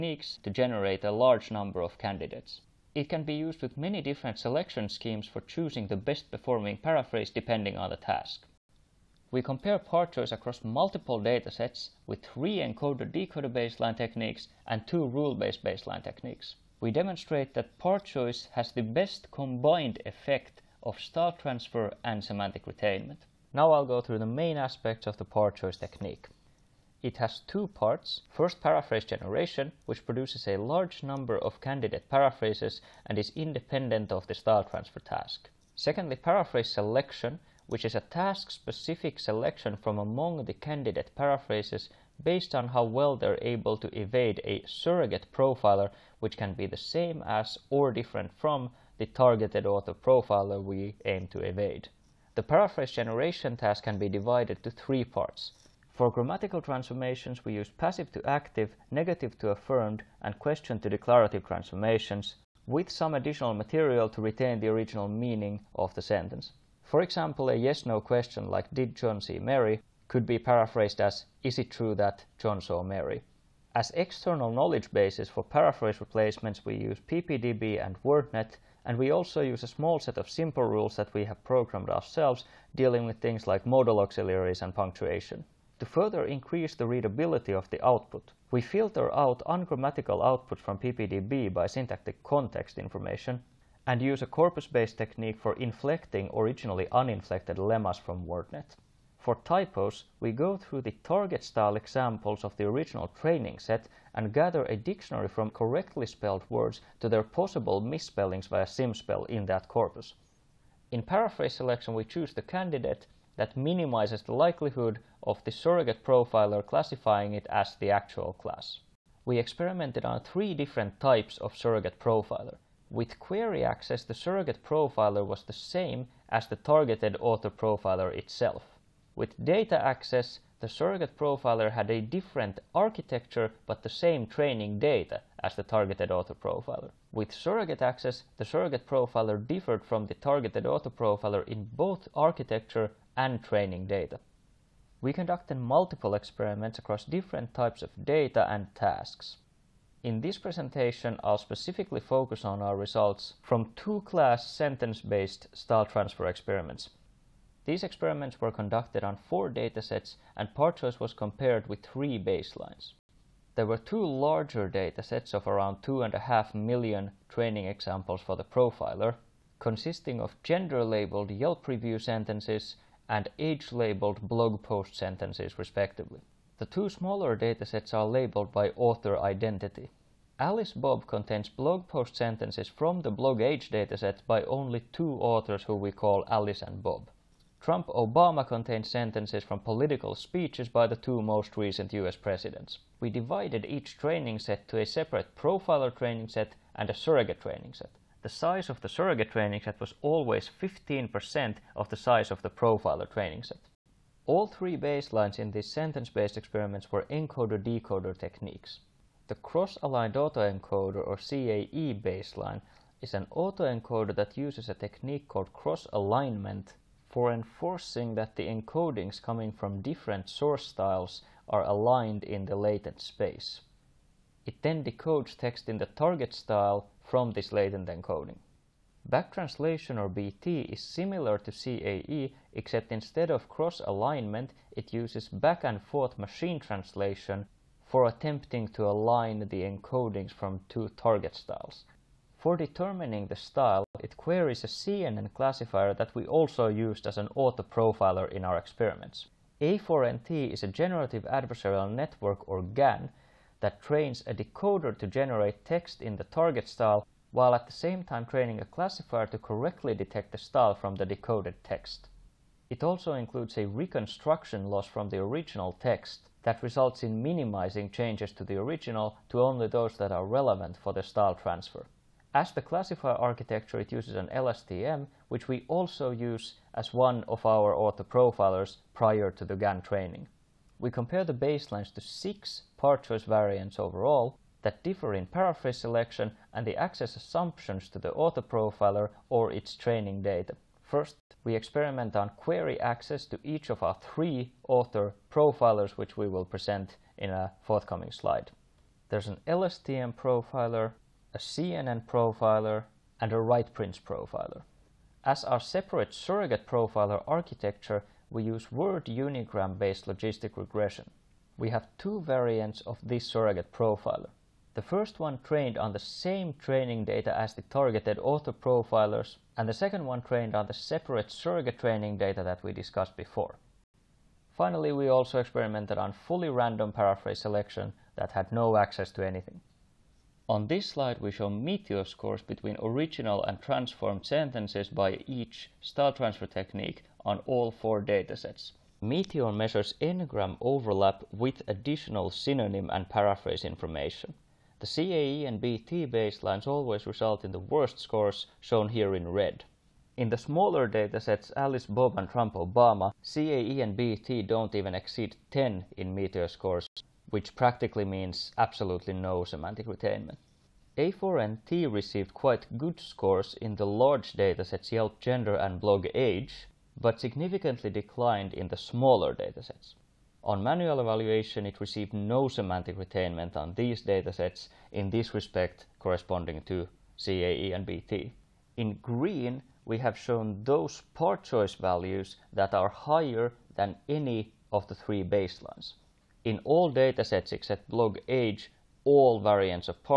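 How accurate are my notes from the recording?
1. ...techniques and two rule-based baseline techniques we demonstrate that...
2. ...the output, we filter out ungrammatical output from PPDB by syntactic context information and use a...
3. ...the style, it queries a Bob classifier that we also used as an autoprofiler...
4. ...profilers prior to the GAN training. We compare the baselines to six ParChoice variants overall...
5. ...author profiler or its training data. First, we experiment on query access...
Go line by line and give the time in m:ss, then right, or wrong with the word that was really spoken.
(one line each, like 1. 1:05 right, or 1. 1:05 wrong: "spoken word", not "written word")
1. 0:13 right
2. 1:27 right
3. 4:03 wrong: "CNN", not "Bob"
4. 4:38 right
5. 4:48 right.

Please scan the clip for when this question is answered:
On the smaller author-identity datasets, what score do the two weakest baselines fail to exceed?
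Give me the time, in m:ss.
5:55.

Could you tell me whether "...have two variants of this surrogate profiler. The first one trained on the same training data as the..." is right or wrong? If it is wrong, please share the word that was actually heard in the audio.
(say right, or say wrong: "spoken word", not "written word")
right.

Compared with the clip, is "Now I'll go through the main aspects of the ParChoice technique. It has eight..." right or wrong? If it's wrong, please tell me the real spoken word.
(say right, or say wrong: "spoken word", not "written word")
wrong: "two", not "eight".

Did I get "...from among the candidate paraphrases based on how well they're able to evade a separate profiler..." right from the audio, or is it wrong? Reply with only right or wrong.
wrong.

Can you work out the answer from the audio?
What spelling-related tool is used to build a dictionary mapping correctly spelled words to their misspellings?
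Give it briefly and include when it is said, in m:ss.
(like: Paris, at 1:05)
SymSpell, at 1:48.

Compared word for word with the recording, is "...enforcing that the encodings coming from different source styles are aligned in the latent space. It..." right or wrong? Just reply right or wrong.
right.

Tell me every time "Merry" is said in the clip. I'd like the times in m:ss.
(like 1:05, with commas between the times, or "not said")
not said.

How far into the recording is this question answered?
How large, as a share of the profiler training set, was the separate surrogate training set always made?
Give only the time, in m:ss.
3:20.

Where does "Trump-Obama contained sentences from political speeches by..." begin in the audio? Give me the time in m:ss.
3:07.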